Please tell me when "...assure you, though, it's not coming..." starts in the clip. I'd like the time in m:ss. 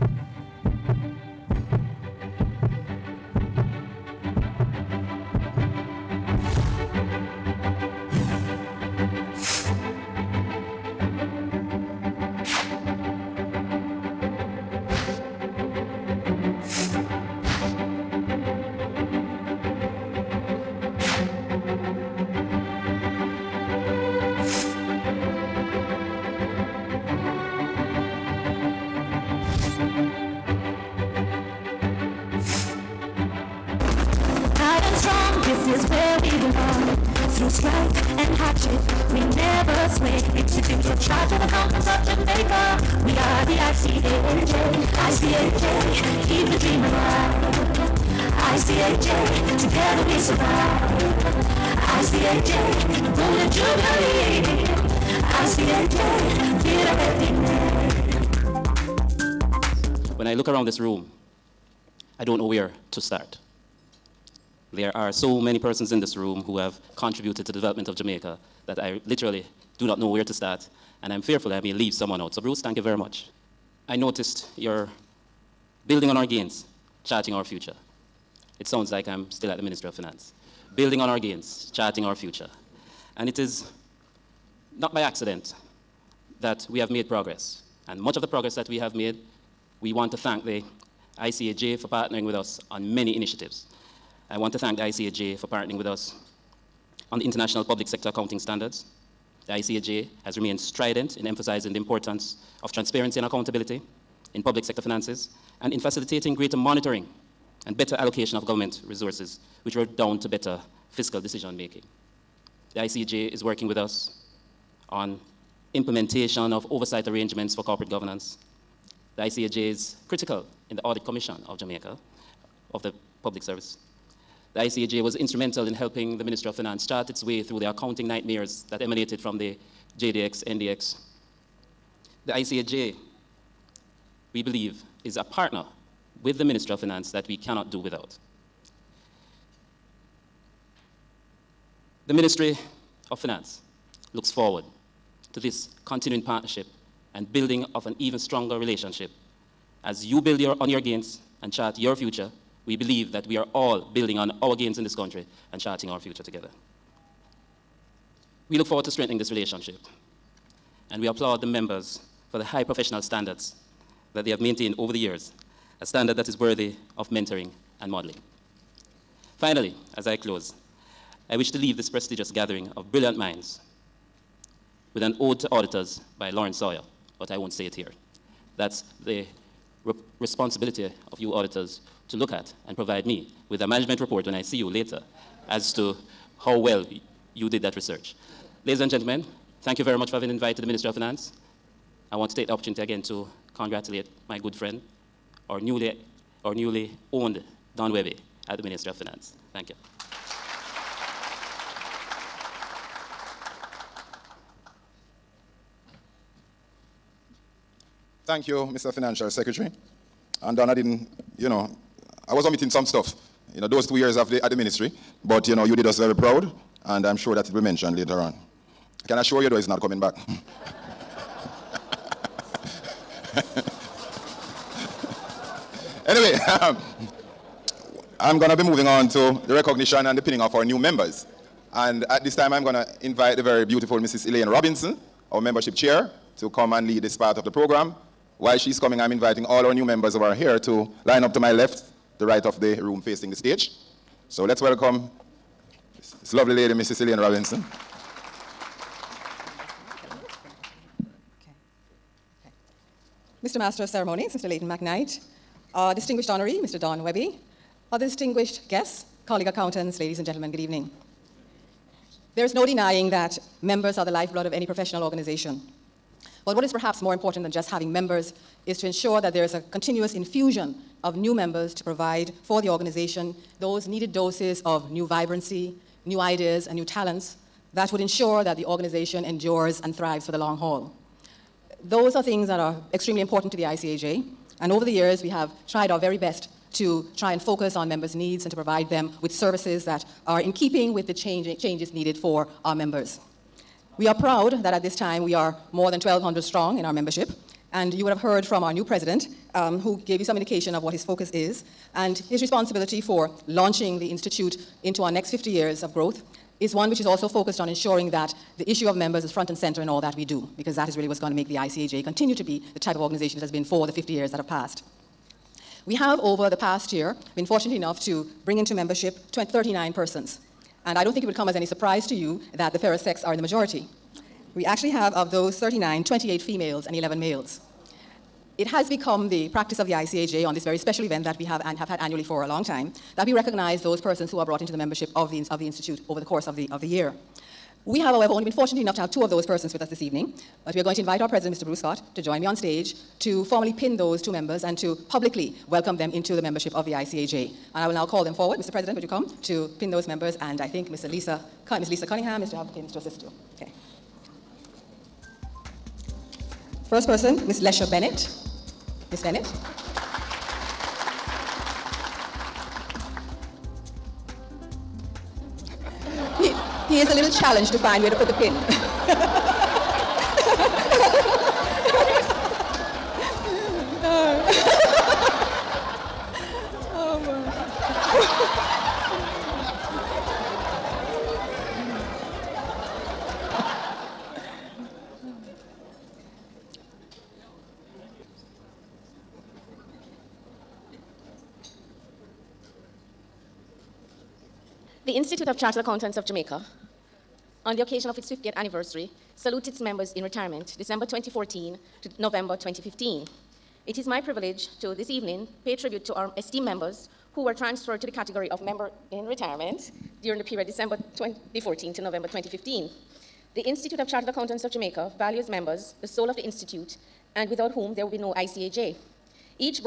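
3:39.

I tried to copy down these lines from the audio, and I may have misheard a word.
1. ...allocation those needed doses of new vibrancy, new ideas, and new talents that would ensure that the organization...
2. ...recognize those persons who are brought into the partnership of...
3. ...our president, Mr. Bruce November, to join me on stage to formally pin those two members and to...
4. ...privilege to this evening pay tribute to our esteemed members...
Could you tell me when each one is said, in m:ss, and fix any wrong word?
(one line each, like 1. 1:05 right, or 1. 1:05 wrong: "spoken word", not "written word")
1. 4:32 wrong: "organization", not "allocation"
2. 5:33 wrong: "membership", not "partnership"
3. 5:41 wrong: "Scott", not "November"
4. 6:44 right.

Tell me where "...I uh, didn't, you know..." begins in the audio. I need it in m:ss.
3:30.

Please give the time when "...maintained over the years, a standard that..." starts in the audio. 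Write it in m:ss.
2:44.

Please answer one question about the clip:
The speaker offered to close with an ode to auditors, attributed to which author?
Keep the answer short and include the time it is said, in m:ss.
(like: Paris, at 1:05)
Lawrence Sawyer, at 2:56.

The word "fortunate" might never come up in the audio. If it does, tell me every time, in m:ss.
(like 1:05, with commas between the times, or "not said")
5:17, 5:38.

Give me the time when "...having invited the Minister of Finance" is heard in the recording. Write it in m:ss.
3:10.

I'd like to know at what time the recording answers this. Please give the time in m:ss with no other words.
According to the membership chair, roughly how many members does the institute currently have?
4:55.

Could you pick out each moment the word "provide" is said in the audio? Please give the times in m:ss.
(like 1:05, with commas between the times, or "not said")
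3:02, 4:31, 4:48.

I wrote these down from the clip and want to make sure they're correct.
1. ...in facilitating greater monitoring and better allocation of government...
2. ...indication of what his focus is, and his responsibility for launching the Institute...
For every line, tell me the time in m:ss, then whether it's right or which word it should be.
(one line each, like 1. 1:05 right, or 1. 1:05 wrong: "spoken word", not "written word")
1. 1:45 right
2. 5:00 right.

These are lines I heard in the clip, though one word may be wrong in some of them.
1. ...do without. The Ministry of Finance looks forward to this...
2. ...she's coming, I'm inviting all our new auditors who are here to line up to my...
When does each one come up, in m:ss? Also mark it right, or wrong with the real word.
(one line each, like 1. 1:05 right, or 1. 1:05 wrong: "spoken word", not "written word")
1. 2:17 right
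2. 3:58 wrong: "members", not "auditors".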